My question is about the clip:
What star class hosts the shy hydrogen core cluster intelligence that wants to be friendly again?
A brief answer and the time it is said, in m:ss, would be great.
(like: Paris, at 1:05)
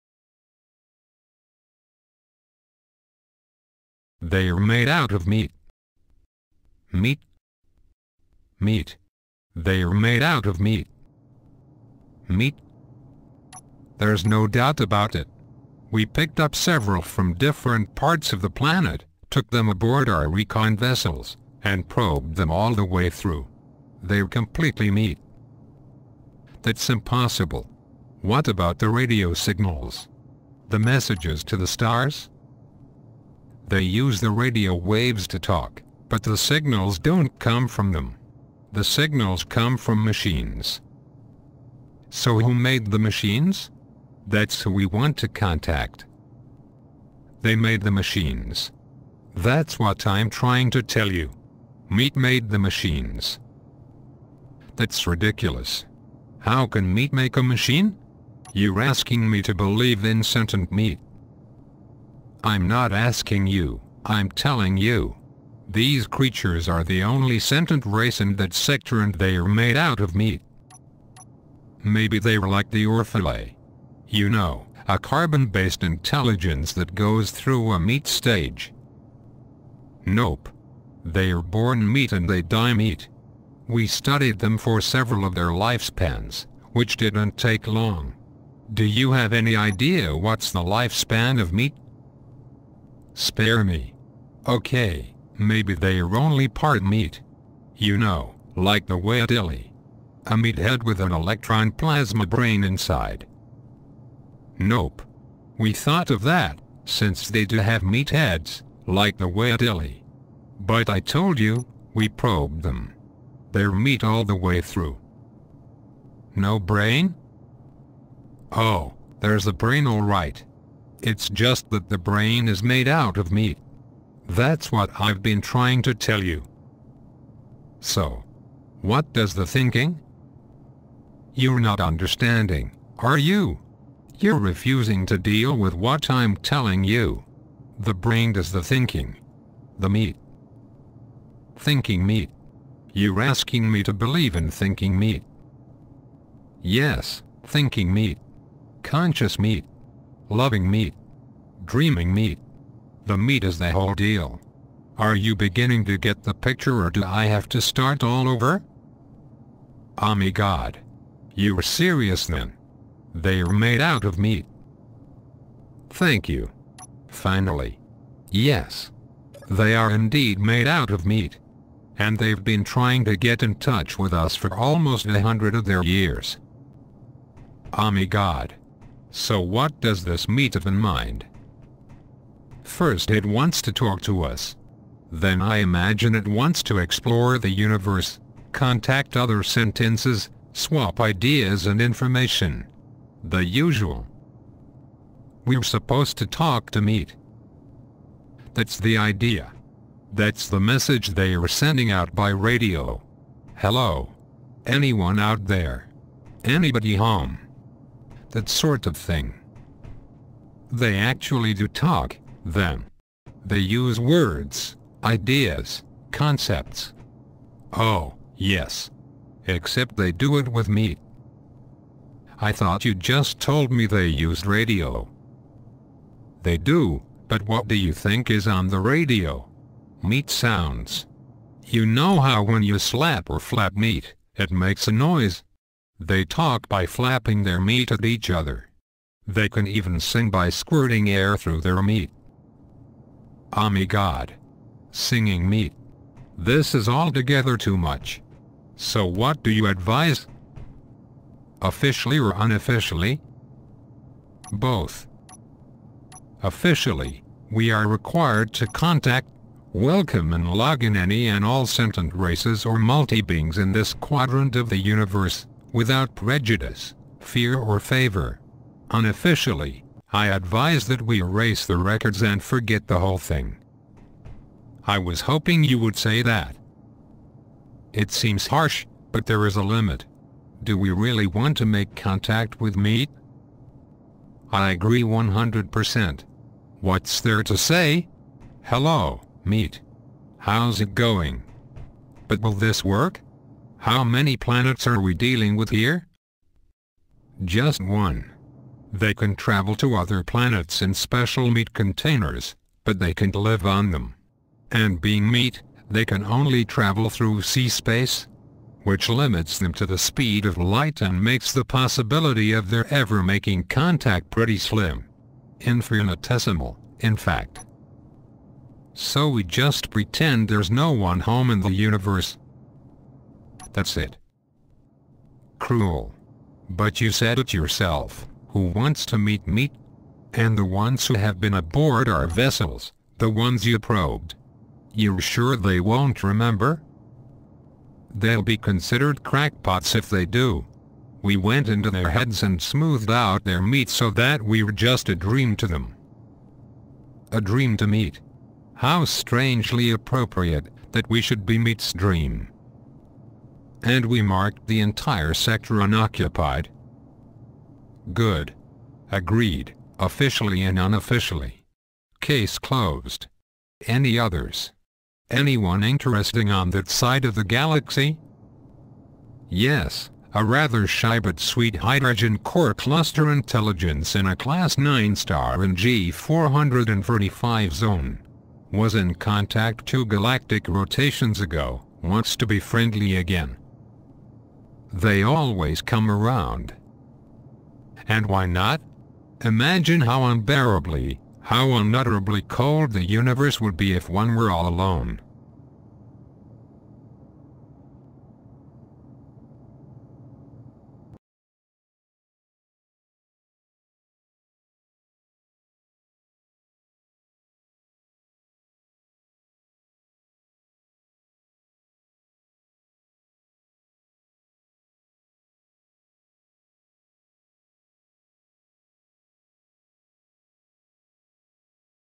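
Class 9, at 6:14.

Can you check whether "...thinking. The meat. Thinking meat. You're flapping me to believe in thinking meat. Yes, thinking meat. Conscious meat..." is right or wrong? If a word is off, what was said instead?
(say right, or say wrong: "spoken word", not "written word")
wrong: "asking", not "flapping".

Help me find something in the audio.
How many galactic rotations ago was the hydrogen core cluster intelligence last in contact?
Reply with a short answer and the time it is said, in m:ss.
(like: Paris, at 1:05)
2, at 6:19.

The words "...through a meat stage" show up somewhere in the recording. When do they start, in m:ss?
1:17.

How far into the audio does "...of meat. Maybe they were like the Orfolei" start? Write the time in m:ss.
1:09.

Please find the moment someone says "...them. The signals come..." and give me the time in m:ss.
0:37.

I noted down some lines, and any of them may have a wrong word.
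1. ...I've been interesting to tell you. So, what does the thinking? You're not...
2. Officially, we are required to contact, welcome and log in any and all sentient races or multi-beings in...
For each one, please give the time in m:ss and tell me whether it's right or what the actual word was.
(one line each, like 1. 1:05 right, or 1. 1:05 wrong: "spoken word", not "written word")
1. 2:04 wrong: "trying", not "interesting"
2. 4:16 right.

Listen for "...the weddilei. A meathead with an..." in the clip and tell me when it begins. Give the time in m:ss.
1:38.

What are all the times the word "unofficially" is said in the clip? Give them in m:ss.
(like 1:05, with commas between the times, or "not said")
4:12, 4:28, 6:00.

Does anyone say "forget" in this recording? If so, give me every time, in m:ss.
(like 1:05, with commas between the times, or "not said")
4:32.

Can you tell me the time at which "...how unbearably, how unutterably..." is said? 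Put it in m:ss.
6:30.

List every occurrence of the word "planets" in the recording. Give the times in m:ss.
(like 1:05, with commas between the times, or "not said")
0:18, 4:54, 5:00.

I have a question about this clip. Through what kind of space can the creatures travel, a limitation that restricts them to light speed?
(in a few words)
C space.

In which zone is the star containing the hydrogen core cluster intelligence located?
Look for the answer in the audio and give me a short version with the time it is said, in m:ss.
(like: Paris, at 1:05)
G435, at 6:15.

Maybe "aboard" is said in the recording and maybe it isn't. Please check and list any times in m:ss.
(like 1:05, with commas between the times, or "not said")
0:19, 5:31.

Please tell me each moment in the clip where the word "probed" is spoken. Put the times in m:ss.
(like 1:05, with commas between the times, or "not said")
0:21, 1:52, 5:33.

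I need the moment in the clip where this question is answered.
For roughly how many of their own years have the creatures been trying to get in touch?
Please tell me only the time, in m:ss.
2:55.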